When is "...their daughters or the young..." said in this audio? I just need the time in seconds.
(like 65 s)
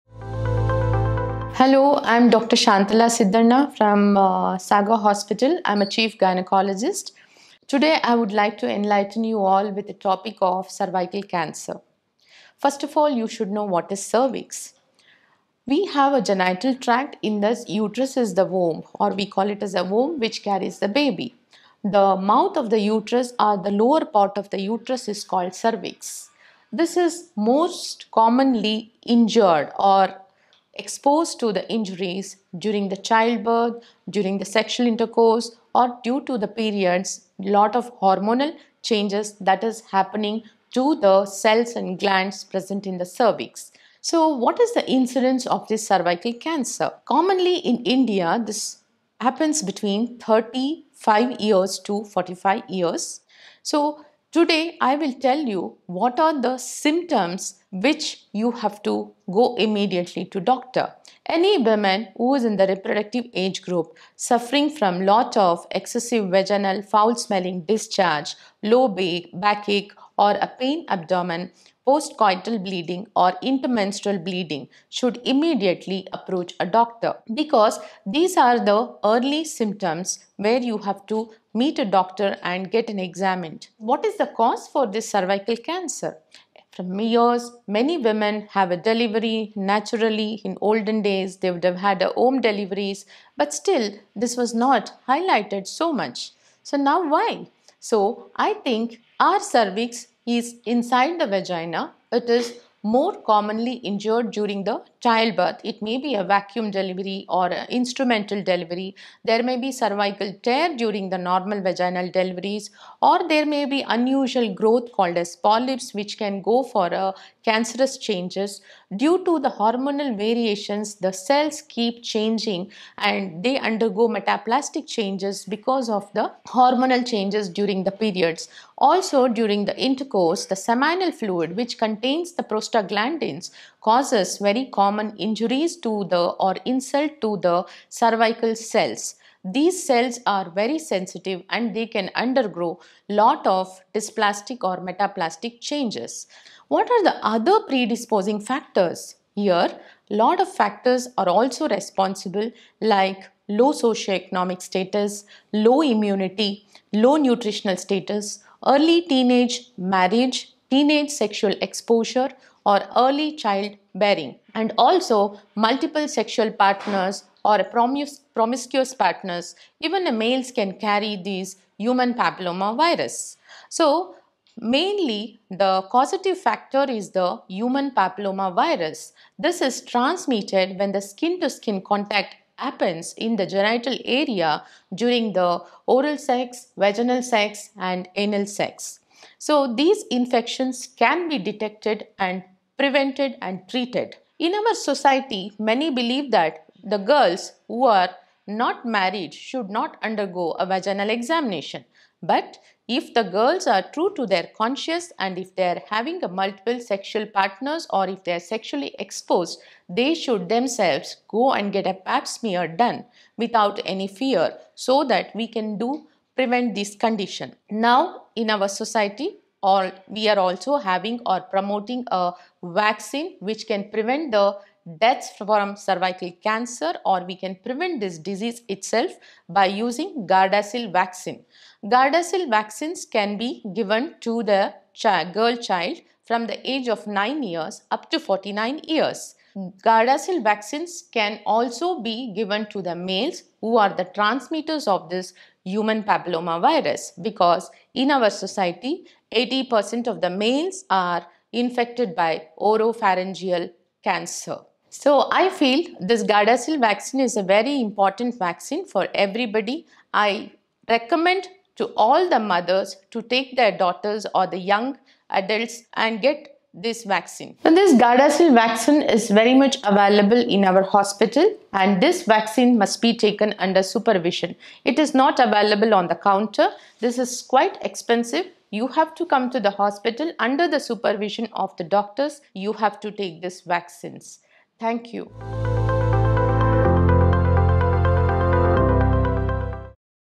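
263 s.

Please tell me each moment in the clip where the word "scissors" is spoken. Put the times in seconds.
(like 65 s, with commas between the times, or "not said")
not said.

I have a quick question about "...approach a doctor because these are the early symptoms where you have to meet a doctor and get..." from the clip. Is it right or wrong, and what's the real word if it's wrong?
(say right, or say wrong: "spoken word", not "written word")
right.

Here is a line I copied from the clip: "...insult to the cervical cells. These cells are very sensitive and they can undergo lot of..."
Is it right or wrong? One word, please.
right.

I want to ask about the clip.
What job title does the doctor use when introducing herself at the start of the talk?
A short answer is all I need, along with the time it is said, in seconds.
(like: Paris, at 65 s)
Chief gynecologist, at 5 s.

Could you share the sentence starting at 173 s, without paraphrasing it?
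So, mainly the causative factor is the human papilloma virus.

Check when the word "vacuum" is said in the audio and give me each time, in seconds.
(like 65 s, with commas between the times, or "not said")
106 s.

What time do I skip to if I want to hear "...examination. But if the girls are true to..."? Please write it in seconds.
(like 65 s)
201 s.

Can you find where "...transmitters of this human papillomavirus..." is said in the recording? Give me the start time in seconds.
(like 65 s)
244 s.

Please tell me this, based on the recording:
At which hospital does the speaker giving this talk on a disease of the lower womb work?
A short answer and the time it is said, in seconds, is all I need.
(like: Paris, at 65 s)
Sagar Hospital, at 4 s.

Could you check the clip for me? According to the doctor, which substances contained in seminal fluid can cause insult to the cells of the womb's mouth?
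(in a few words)
Prostaglandins.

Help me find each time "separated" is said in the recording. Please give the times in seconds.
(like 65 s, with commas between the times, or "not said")
not said.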